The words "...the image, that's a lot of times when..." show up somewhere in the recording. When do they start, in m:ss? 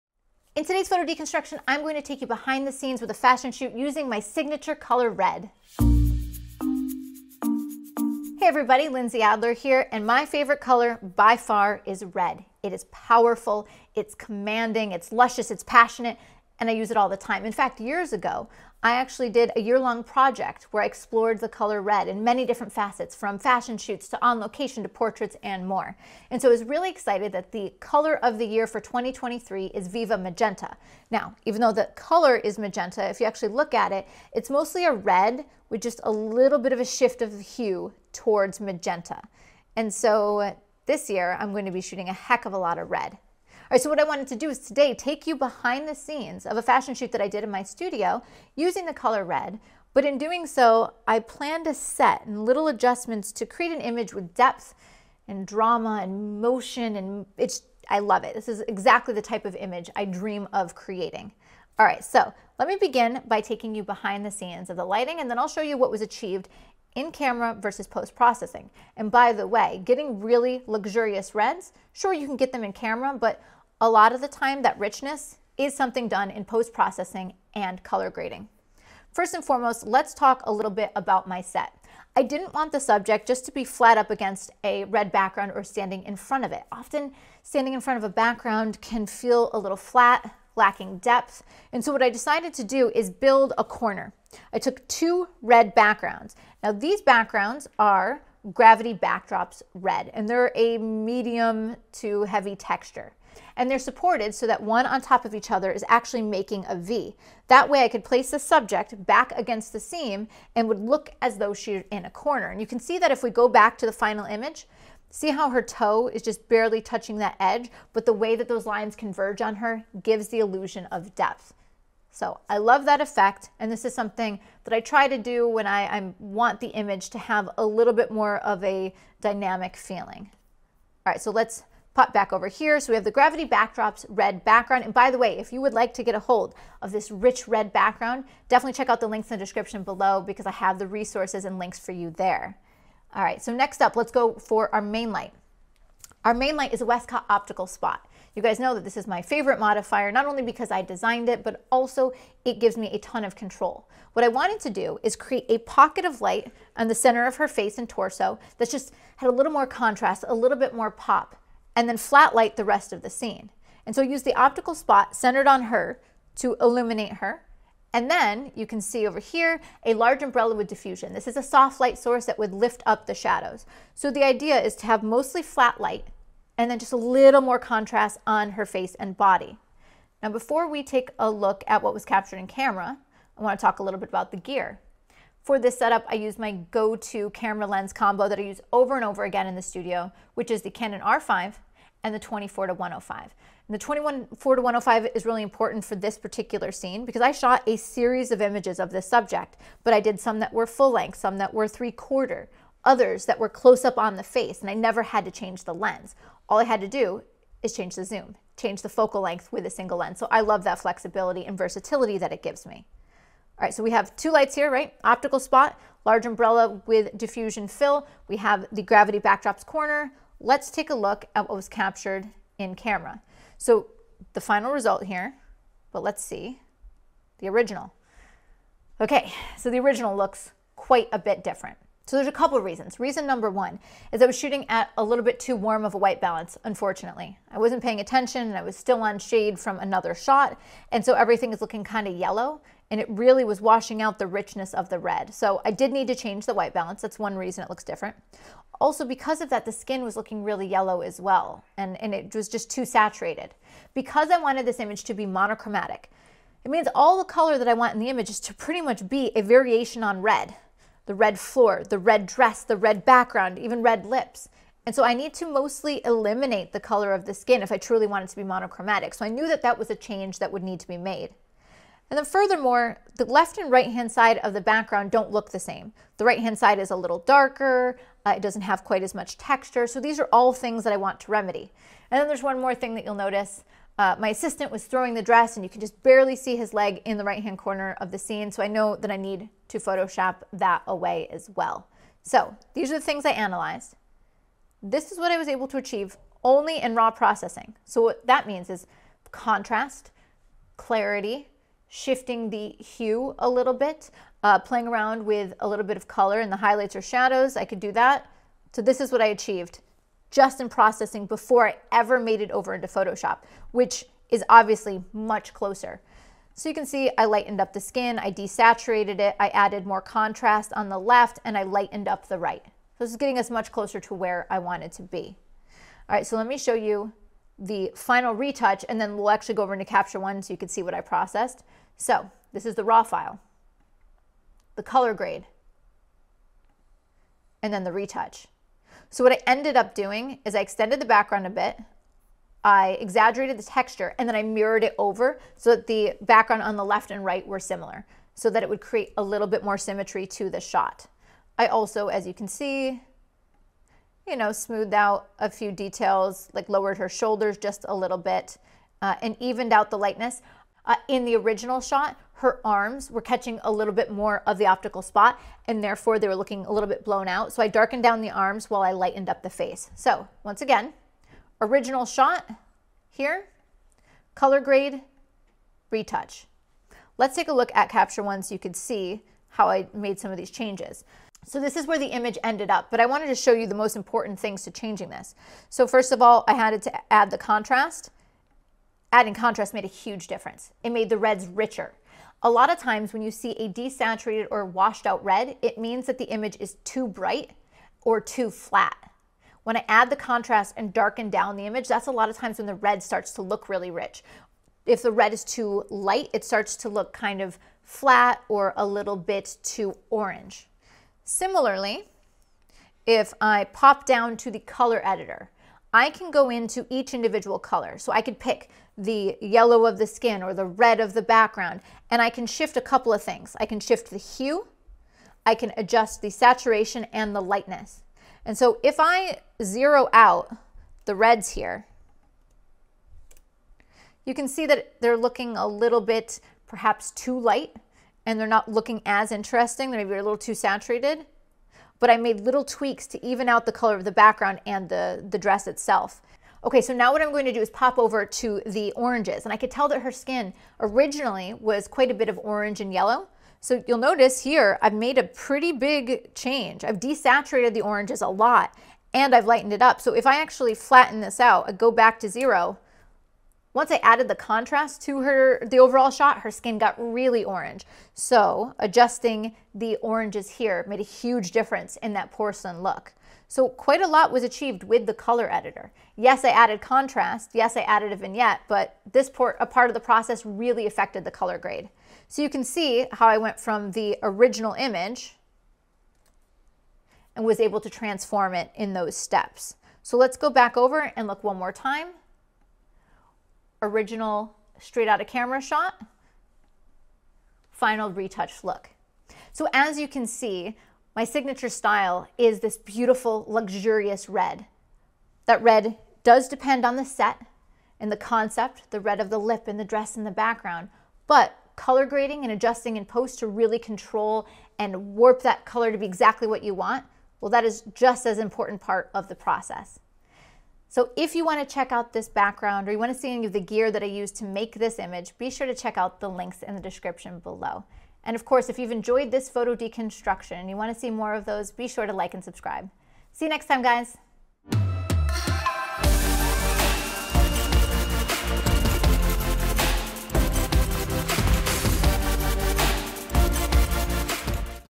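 6:41.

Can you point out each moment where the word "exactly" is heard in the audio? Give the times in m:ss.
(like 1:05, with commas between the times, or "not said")
0:58, 8:36.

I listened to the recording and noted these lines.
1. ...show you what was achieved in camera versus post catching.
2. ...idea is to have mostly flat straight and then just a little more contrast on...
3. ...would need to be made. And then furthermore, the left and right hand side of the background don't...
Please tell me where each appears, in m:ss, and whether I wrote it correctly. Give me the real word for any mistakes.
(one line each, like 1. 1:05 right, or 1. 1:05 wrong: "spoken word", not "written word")
1. 1:05 wrong: "processing", not "catching"
2. 2:54 wrong: "light", not "straight"
3. 4:30 right.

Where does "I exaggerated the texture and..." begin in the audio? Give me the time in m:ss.
5:42.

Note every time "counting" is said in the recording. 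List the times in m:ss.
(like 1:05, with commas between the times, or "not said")
not said.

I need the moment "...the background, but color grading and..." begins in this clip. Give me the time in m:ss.
8:30.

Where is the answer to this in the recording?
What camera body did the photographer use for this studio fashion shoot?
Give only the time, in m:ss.
3:10.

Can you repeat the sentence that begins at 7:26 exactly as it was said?
Okay, so now what I'm going to do is pop over to the oranges.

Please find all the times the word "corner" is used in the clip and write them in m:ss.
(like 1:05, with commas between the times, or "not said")
1:33, 1:52, 3:39, 4:47.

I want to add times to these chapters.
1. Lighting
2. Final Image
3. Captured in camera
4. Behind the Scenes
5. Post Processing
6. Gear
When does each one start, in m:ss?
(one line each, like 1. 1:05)
1. 2:22
2. 5:31
3. 3:43
4. 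1:18
5. 6:16
6. 2:59.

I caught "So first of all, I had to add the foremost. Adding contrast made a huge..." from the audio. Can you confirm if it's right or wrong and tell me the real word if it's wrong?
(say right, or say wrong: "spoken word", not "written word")
wrong: "contrast", not "foremost".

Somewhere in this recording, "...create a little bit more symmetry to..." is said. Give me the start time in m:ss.
5:48.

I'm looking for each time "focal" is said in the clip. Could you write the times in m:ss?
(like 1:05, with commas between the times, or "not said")
3:28.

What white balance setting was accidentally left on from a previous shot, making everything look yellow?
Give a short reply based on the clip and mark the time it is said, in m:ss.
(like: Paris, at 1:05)
Shade, at 3:59.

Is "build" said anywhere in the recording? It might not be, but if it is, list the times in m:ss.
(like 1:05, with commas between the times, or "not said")
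1:33.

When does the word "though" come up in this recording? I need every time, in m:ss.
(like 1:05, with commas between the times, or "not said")
0:31, 1:51.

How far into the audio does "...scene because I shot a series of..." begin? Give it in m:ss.
3:16.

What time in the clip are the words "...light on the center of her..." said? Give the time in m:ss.
2:36.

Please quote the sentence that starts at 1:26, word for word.
Often standing in front of a background can feel a little flat, lacking depth.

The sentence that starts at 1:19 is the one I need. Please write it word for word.
First and foremost, let's talk a little bit about my set.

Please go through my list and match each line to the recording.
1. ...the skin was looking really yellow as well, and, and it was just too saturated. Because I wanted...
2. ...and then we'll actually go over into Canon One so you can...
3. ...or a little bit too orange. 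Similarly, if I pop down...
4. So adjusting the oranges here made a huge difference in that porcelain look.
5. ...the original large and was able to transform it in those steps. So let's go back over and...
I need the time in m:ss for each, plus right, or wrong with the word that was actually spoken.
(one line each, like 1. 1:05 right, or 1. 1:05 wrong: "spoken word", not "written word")
1. 4:09 right
2. 5:28 wrong: "Capture", not "Canon"
3. 6:48 right
4. 7:48 right
5. 8:03 wrong: "image", not "large".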